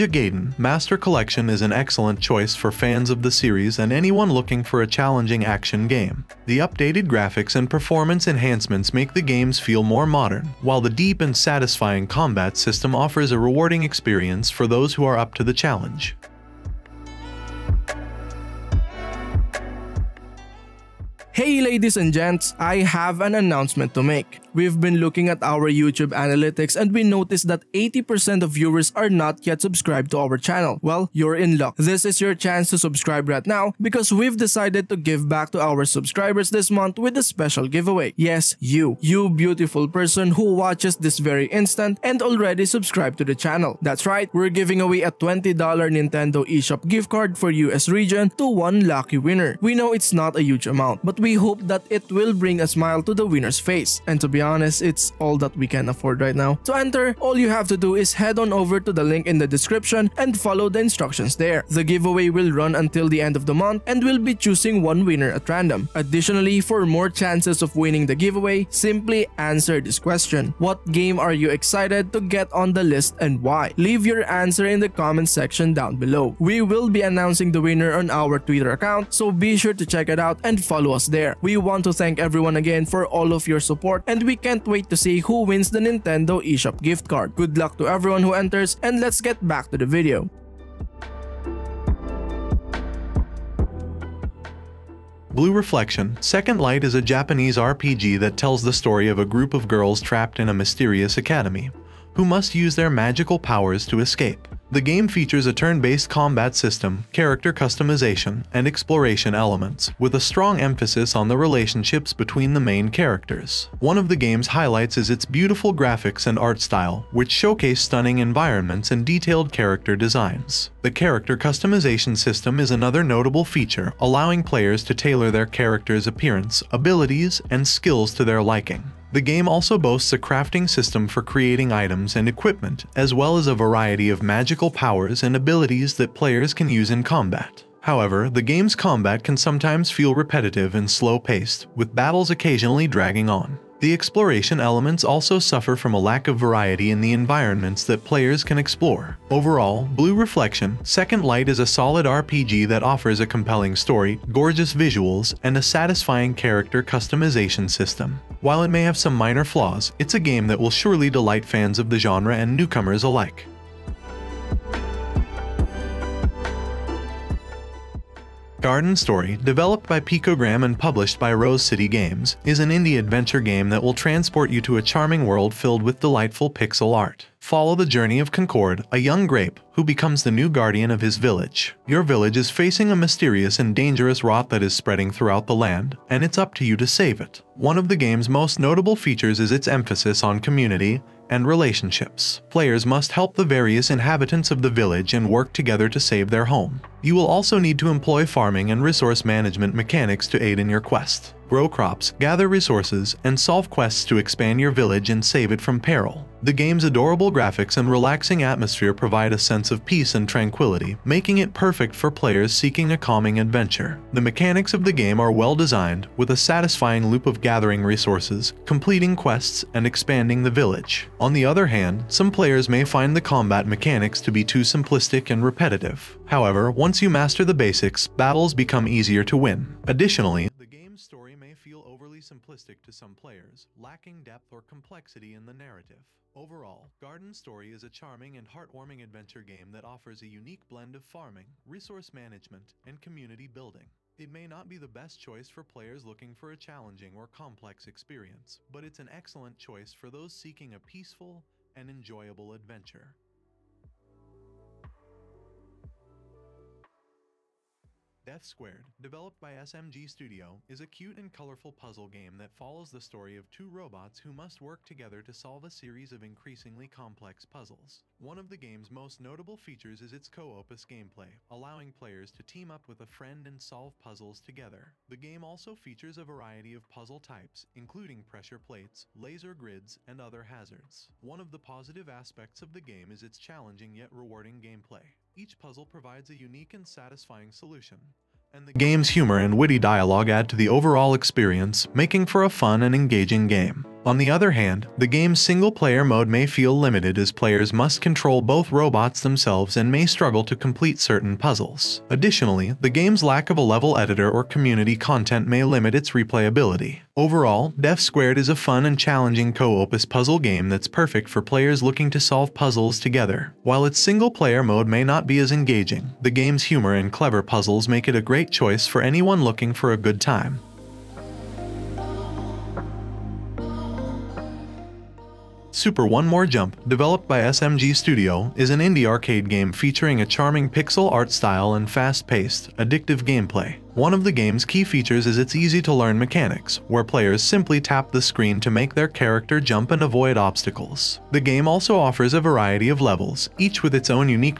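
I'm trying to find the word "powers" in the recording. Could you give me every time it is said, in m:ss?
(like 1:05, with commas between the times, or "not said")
1:43, 2:14.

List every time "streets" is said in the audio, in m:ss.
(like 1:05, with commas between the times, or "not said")
not said.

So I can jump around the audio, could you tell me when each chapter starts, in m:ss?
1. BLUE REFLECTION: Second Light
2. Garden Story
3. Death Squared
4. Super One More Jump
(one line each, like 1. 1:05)
1. 1:35
2. 2:48
3. 4:18
4. 5:25.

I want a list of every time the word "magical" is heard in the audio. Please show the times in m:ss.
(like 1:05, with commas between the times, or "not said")
1:42, 2:14.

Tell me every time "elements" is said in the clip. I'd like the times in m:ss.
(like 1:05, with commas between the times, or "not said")
1:49, 2:24.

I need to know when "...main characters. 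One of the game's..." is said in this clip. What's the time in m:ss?
1:52.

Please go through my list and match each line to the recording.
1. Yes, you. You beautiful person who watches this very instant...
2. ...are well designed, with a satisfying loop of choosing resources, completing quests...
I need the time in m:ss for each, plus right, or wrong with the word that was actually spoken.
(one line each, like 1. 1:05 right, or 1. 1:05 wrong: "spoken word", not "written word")
1. 0:38 right
2. 3:35 wrong: "gathering", not "choosing".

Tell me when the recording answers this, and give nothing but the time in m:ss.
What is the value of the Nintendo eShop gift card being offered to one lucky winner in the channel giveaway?
0:45.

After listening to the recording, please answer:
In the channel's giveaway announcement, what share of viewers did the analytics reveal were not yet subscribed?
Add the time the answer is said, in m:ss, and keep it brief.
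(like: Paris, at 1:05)
80%, at 0:27.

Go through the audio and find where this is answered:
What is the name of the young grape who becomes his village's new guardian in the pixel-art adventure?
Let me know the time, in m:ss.
2:58.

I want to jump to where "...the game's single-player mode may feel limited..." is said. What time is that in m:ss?
4:54.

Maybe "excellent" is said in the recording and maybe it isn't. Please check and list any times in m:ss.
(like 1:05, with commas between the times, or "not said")
0:01, 4:09.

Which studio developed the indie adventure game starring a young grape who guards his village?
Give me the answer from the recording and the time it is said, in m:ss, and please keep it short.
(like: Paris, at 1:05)
Picogram, at 2:49.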